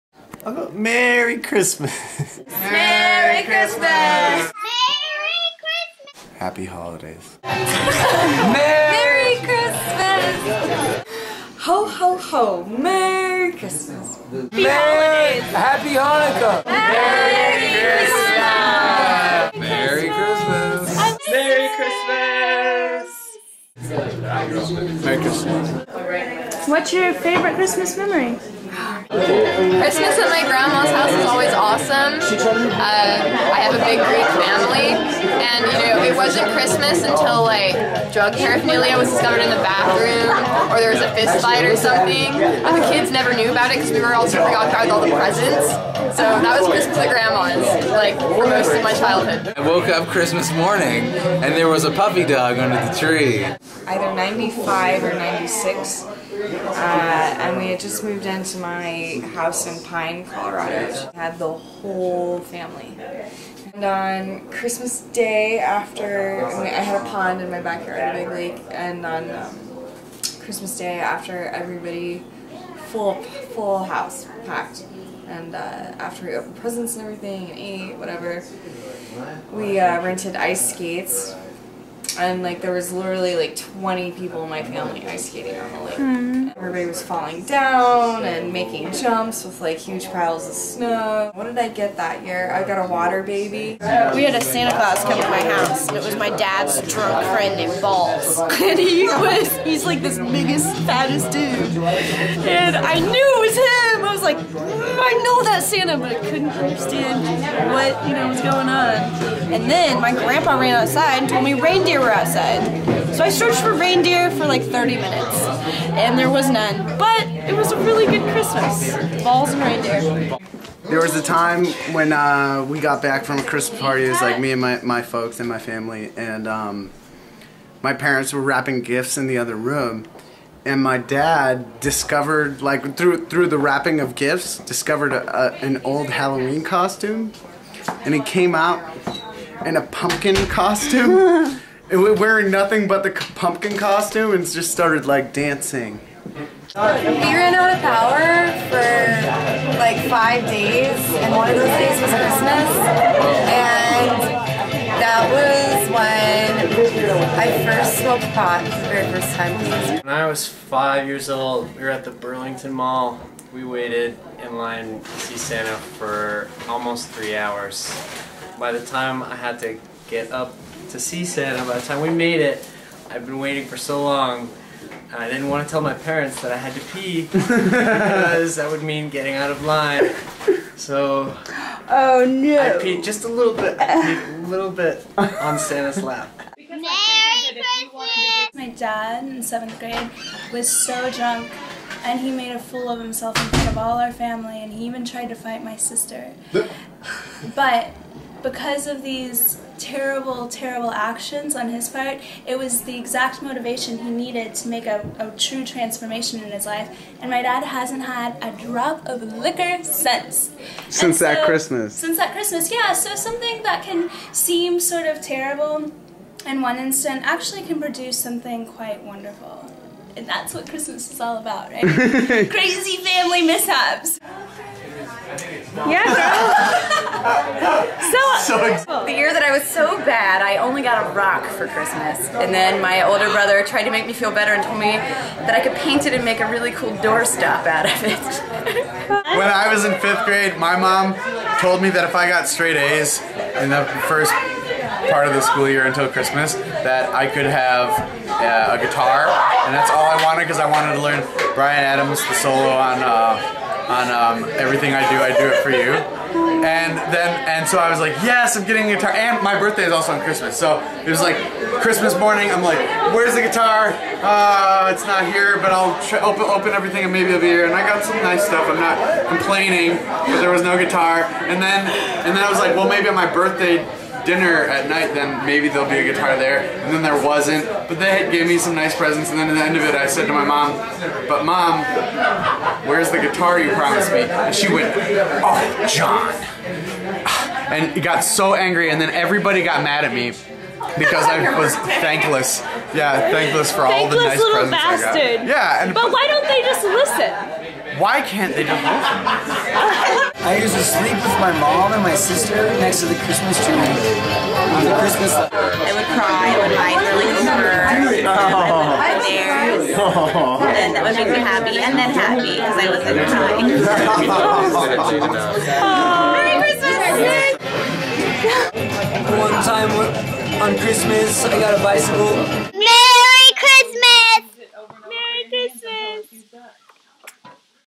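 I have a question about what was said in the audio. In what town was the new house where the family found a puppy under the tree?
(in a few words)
Pine, Colorado.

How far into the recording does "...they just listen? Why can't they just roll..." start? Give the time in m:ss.
4:56.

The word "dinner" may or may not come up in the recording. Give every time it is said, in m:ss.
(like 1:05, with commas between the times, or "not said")
4:34.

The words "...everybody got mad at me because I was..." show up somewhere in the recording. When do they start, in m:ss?
4:49.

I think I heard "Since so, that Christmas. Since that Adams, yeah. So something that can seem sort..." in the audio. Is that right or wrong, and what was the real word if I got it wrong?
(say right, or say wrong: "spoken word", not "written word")
wrong: "Christmas", not "Adams".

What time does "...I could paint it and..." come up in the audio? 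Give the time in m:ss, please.
3:55.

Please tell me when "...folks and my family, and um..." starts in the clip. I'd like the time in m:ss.
2:05.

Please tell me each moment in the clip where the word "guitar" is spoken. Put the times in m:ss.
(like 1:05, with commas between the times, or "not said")
4:08, 4:18, 4:23, 4:30, 4:36, 4:43.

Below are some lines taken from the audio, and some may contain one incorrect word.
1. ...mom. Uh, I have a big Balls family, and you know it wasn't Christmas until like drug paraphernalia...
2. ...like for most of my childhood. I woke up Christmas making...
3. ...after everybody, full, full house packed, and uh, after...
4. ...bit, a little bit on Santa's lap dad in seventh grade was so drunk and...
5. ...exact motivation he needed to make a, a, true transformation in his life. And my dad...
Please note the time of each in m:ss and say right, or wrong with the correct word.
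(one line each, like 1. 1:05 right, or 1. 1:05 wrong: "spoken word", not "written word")
1. 0:32 wrong: "Greek", not "Balls"
2. 0:47 wrong: "morning", not "making"
3. 1:10 right
4. 3:03 right
5. 3:22 right.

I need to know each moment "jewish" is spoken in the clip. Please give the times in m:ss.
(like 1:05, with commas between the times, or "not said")
not said.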